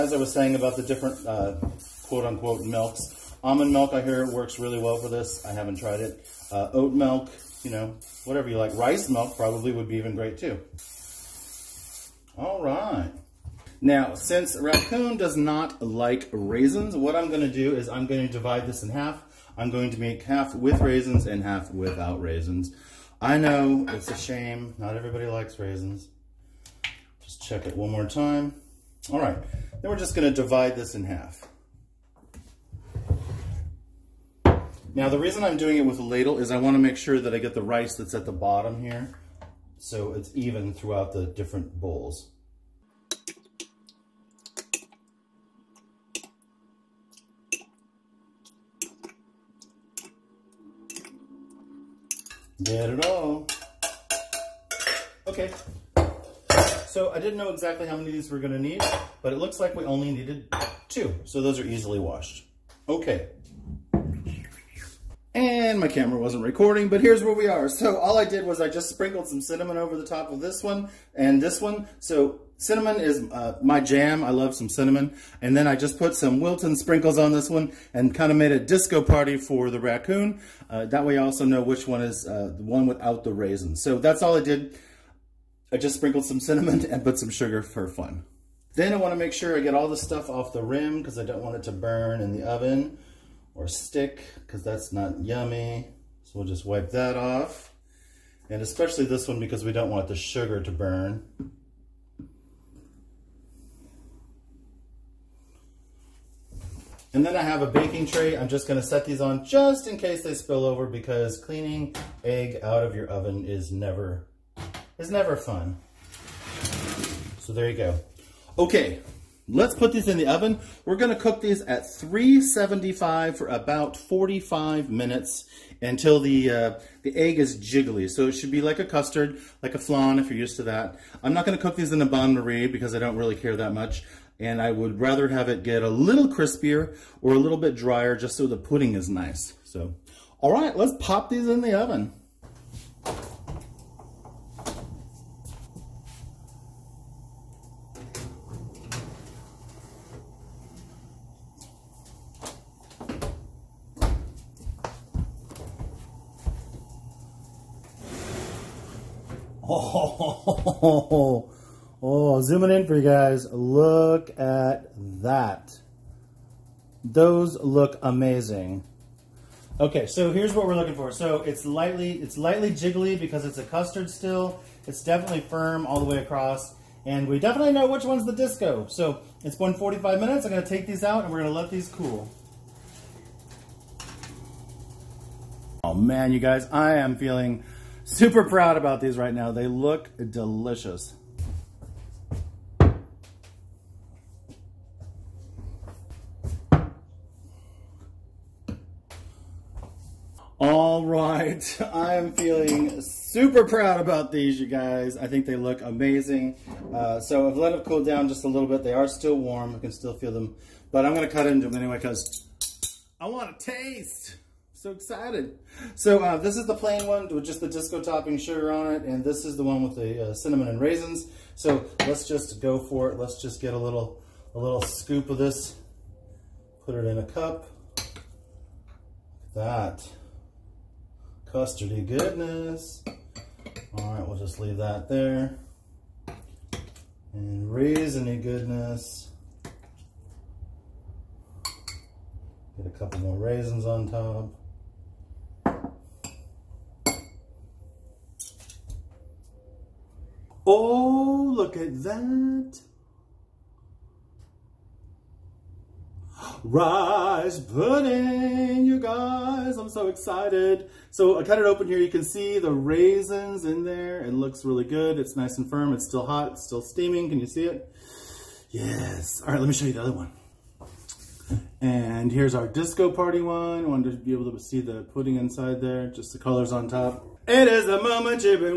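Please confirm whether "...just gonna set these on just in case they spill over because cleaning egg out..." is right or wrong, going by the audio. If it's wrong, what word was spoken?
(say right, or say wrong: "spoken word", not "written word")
right.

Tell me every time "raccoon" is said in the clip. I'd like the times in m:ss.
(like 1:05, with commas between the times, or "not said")
0:14, 1:19.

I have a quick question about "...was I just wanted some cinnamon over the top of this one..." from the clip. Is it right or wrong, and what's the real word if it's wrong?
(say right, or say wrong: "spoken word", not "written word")
wrong: "sprinkled", not "wanted".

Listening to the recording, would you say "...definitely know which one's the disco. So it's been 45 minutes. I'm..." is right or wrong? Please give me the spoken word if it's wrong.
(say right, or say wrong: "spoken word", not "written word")
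right.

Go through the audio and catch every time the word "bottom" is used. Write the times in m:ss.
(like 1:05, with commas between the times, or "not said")
0:38.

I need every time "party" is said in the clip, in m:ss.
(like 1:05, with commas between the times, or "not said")
1:19, 4:33.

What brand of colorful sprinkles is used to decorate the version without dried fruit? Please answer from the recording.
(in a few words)
Wilton.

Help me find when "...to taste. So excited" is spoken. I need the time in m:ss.
3:33.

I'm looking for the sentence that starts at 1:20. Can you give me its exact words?
Uh, that way I also know which one is uh, the one without the raisins.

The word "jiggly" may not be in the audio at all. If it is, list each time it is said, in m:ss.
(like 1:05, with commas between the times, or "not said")
2:07, 2:52.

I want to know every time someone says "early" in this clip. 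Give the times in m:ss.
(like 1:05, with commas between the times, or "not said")
not said.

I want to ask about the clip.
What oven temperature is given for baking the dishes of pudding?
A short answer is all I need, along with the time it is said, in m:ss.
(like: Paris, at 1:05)
375, at 2:01.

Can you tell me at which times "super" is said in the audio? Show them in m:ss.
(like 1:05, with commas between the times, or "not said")
3:08, 3:23.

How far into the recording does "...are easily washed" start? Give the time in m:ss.
1:01.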